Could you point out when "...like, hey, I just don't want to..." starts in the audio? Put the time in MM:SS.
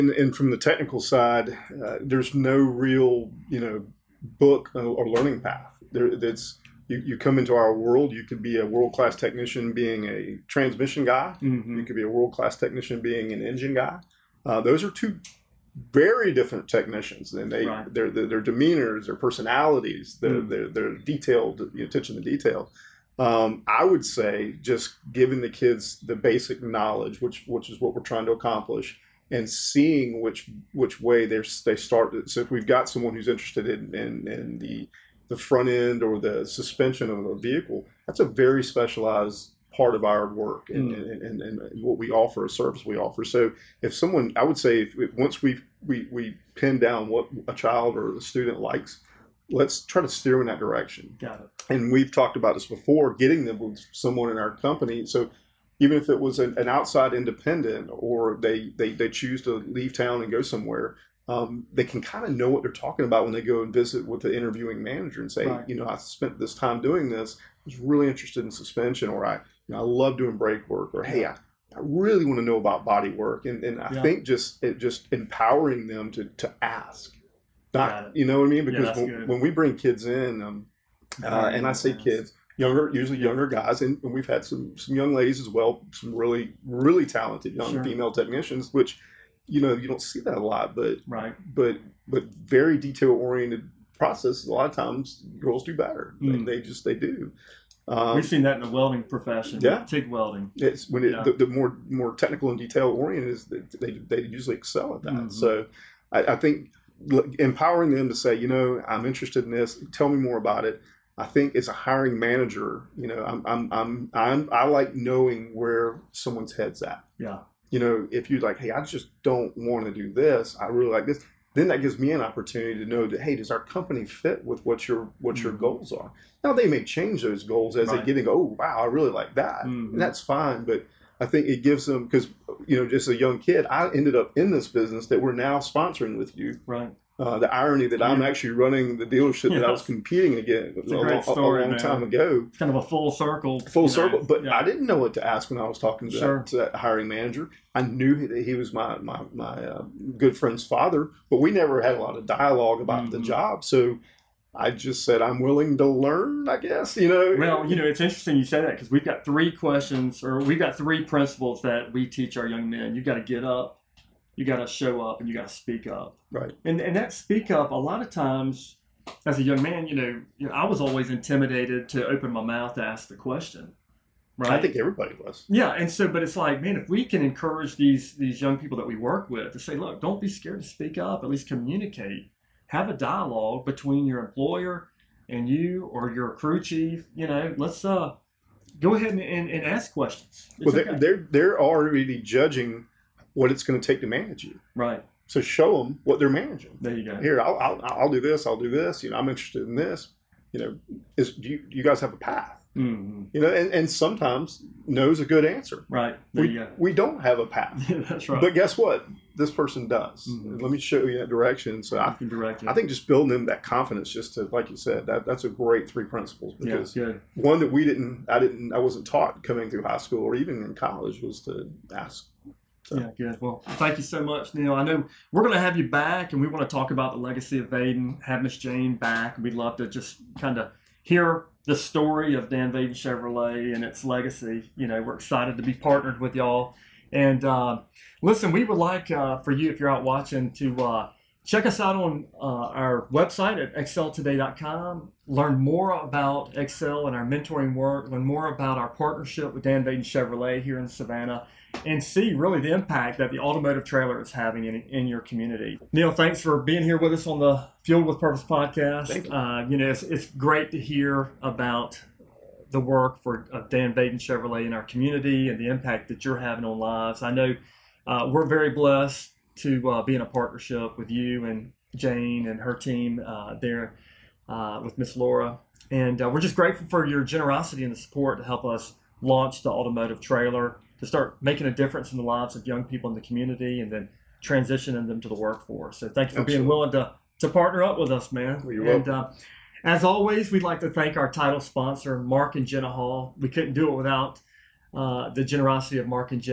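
01:58.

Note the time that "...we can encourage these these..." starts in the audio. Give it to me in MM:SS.
02:56.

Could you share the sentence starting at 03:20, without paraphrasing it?
You know, is do you, do you guys have a path?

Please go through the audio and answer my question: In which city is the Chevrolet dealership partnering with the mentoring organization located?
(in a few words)
Savannah.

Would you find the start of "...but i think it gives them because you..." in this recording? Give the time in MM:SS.
02:10.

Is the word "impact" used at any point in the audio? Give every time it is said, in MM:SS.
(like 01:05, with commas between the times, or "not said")
04:12, 04:25.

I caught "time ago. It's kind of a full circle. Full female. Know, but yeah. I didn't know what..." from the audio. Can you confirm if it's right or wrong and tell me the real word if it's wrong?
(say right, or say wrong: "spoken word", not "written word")
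wrong: "circle", not "female".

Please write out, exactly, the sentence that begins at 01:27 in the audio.
female technicians, which, you know, you don't see that a lot, but, right.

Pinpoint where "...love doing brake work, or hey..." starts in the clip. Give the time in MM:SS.
01:09.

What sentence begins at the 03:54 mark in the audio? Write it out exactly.
You know, we're excited to be partnered with y'all.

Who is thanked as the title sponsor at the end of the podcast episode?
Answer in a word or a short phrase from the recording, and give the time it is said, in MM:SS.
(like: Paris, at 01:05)
Mark and Jenna Hall, at 04:52.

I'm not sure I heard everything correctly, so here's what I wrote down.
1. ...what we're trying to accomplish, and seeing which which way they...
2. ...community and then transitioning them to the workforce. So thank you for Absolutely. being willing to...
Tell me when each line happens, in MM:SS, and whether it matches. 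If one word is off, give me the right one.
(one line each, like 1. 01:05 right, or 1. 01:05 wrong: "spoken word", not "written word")
1. 00:27 right
2. 04:43 right.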